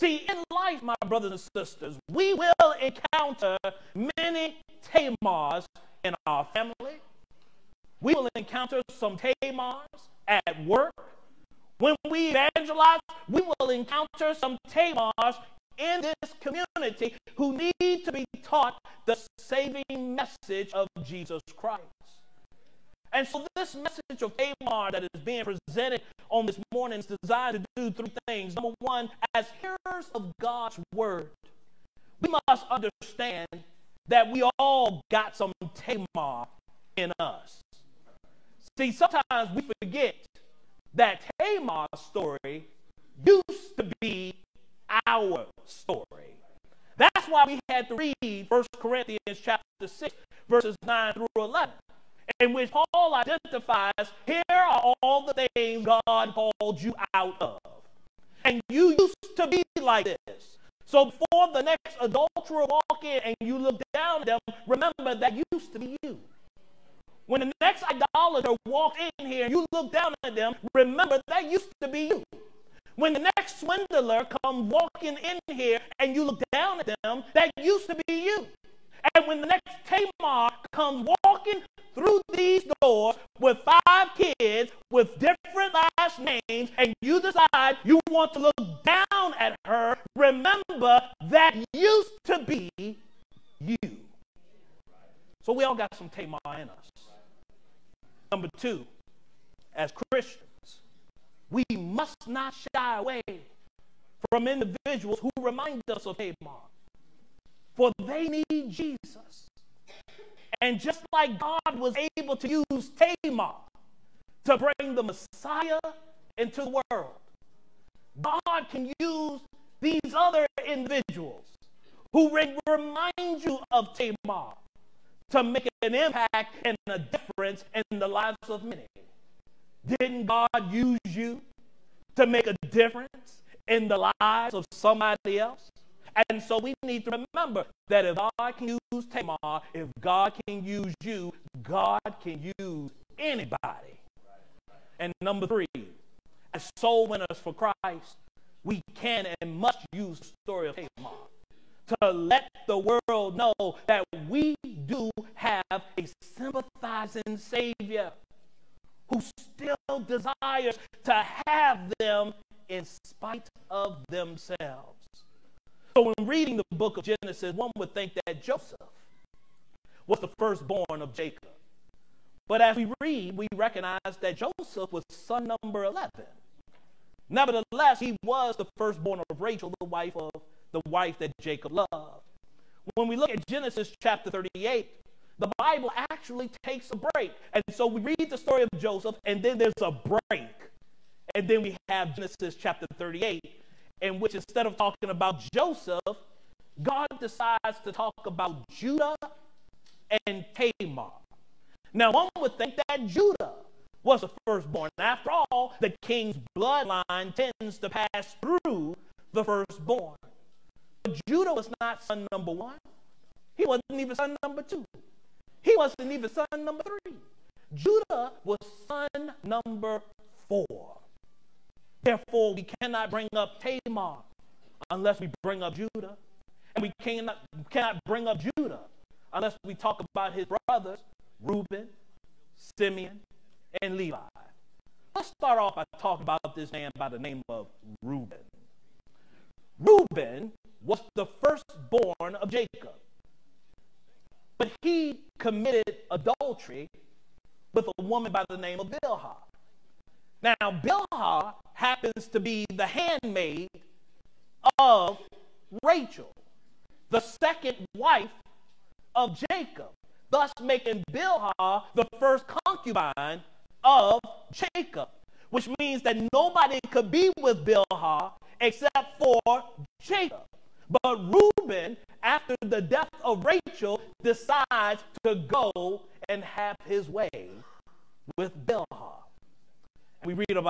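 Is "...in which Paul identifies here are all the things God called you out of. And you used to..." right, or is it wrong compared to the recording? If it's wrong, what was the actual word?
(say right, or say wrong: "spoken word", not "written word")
right.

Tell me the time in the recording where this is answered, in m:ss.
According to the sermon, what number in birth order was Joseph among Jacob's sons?
2:55.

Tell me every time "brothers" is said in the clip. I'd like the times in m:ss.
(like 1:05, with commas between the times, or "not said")
0:01, 3:50.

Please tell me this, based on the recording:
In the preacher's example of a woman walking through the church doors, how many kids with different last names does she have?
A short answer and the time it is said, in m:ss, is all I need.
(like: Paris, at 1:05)
5, at 1:23.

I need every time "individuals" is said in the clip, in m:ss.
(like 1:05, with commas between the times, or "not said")
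1:44, 2:00.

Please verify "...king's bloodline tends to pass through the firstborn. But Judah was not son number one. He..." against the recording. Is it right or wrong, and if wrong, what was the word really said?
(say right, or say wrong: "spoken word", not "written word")
right.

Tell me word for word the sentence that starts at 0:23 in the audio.
And so, this message of Tamar that is being presented on this morning is designed to do three things.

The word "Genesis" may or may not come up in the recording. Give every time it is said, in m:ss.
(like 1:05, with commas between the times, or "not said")
2:47, 3:03, 3:12.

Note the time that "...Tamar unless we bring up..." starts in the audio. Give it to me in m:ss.
3:43.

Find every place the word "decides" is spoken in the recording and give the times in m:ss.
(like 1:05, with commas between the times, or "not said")
1:27, 3:17, 4:34.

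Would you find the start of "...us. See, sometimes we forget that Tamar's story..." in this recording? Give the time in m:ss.
0:37.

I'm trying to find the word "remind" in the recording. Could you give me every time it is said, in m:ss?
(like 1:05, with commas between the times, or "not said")
1:45, 2:02.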